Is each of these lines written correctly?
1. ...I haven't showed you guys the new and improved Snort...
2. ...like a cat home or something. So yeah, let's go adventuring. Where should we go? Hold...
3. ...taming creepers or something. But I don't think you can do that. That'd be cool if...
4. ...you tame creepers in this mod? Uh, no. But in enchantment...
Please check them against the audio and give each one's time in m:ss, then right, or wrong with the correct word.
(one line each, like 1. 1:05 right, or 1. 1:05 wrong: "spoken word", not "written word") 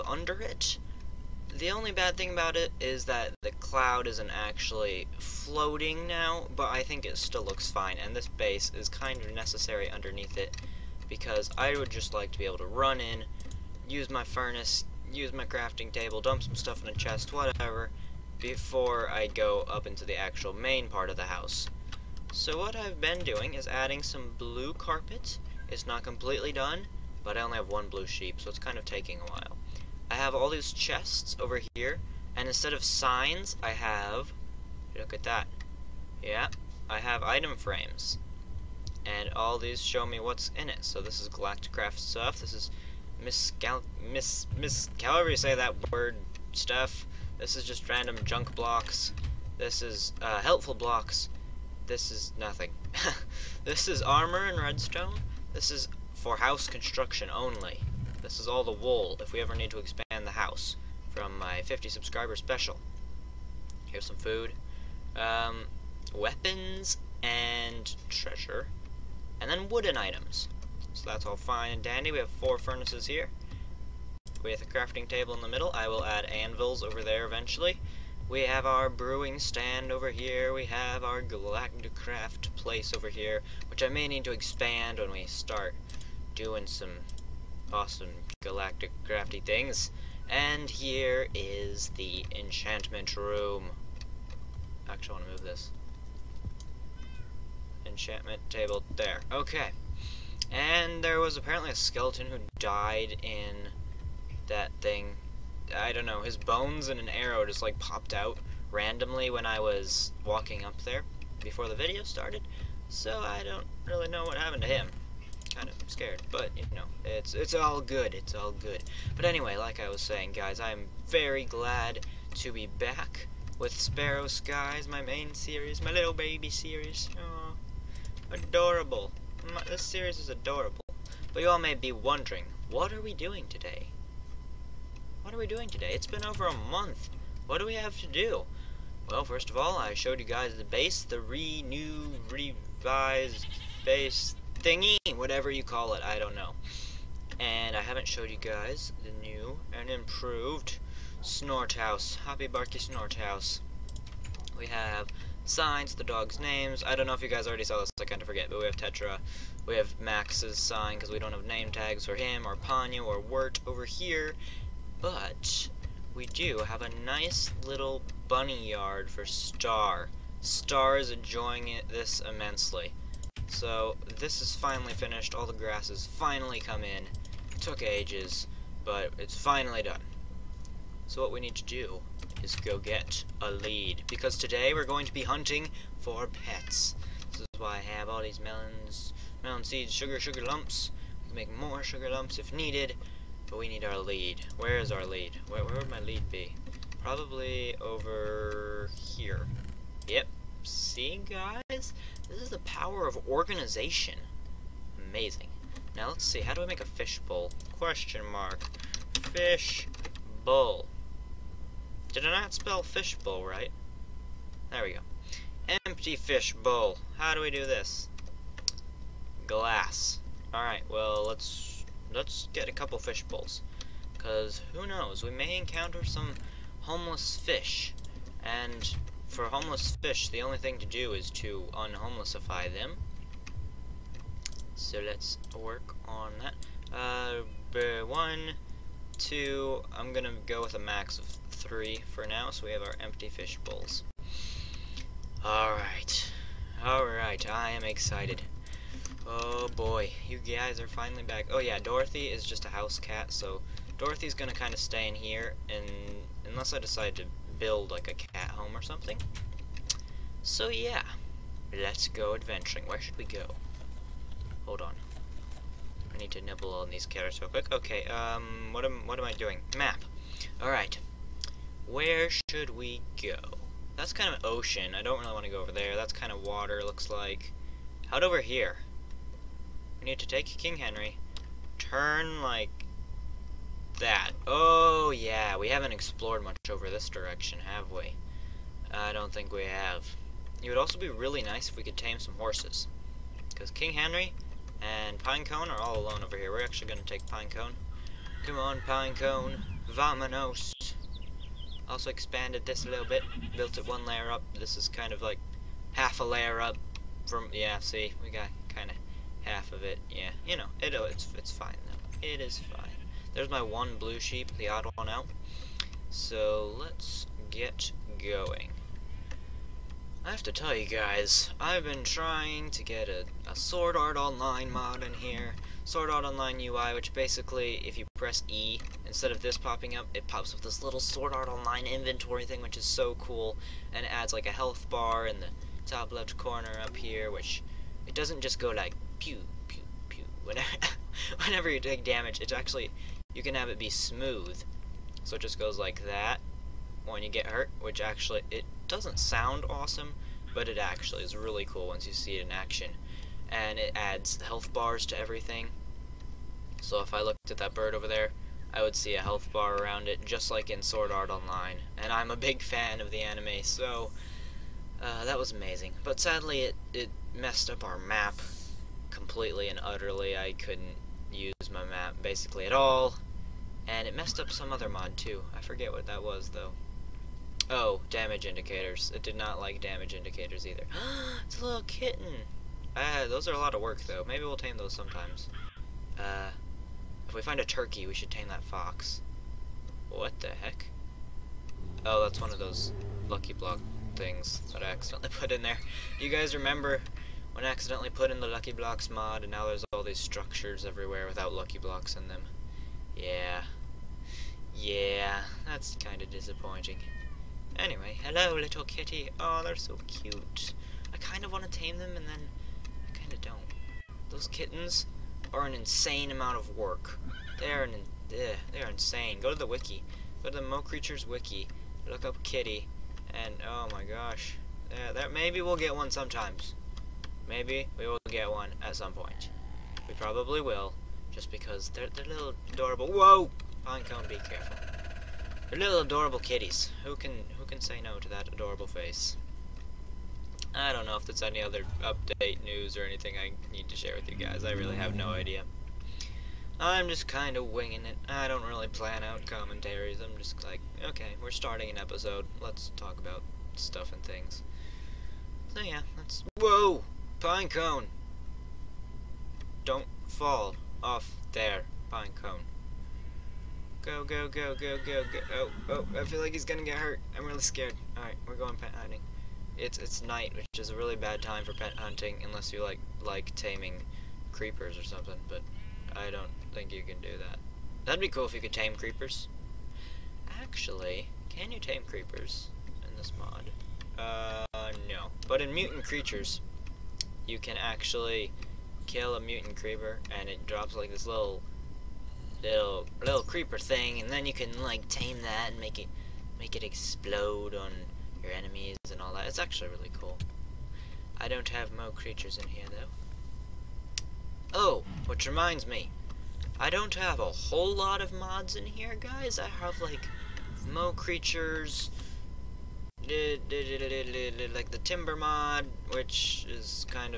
1. 2:27 wrong: "House", not "Snort"
2. 4:17 right
3. 7:53 right
4. 8:01 wrong: "mutant", not "enchantment".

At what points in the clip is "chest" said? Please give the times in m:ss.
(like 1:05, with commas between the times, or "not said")
0:16, 0:30.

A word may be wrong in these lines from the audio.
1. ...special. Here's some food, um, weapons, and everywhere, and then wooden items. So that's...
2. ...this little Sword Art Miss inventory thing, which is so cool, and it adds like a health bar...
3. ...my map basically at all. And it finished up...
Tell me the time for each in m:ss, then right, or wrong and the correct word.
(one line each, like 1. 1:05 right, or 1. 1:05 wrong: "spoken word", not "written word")
1. 1:02 wrong: "treasure", not "everywhere"
2. 5:30 wrong: "Online", not "Miss"
3. 6:11 wrong: "messed", not "finished".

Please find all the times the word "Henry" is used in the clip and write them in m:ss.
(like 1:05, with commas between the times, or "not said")
4:40, 4:53.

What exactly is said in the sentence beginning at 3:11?
We can make more sugar lumps if needed, but we need our lead.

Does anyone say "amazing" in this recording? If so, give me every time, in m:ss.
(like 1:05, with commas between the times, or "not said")
3:25, 6:05.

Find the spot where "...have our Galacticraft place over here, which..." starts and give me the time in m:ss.
1:20.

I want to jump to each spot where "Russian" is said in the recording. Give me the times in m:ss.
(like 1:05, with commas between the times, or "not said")
not said.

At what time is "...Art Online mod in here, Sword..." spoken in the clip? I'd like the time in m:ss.
5:23.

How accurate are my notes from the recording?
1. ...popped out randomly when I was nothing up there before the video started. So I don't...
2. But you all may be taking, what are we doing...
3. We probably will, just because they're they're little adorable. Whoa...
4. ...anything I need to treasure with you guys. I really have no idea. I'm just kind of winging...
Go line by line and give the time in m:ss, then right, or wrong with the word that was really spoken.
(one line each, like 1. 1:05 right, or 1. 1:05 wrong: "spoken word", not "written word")
1. 1:47 wrong: "walking", not "nothing"
2. 2:11 wrong: "wondering", not "taking"
3. 7:10 right
4. 7:23 wrong: "share", not "treasure".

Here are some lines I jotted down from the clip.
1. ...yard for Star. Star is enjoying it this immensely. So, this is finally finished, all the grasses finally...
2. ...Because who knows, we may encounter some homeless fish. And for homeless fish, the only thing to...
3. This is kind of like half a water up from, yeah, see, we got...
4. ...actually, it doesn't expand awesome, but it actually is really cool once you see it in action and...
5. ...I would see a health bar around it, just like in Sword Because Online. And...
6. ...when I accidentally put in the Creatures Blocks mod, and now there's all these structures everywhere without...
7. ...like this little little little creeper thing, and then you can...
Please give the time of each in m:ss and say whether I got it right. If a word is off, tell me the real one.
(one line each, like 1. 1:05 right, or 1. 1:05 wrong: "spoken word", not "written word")
1. 2:48 right
2. 3:44 right
3. 5:04 wrong: "layer", not "water"
4. 5:48 wrong: "sound", not "expand"
5. 5:58 wrong: "Art", not "Because"
6. 6:37 wrong: "Lucky", not "Creatures"
7. 8:10 right.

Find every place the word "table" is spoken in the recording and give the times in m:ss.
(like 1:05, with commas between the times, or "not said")
0:15, 1:15, 1:38.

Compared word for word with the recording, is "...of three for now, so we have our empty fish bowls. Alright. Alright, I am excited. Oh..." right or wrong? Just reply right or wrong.
right.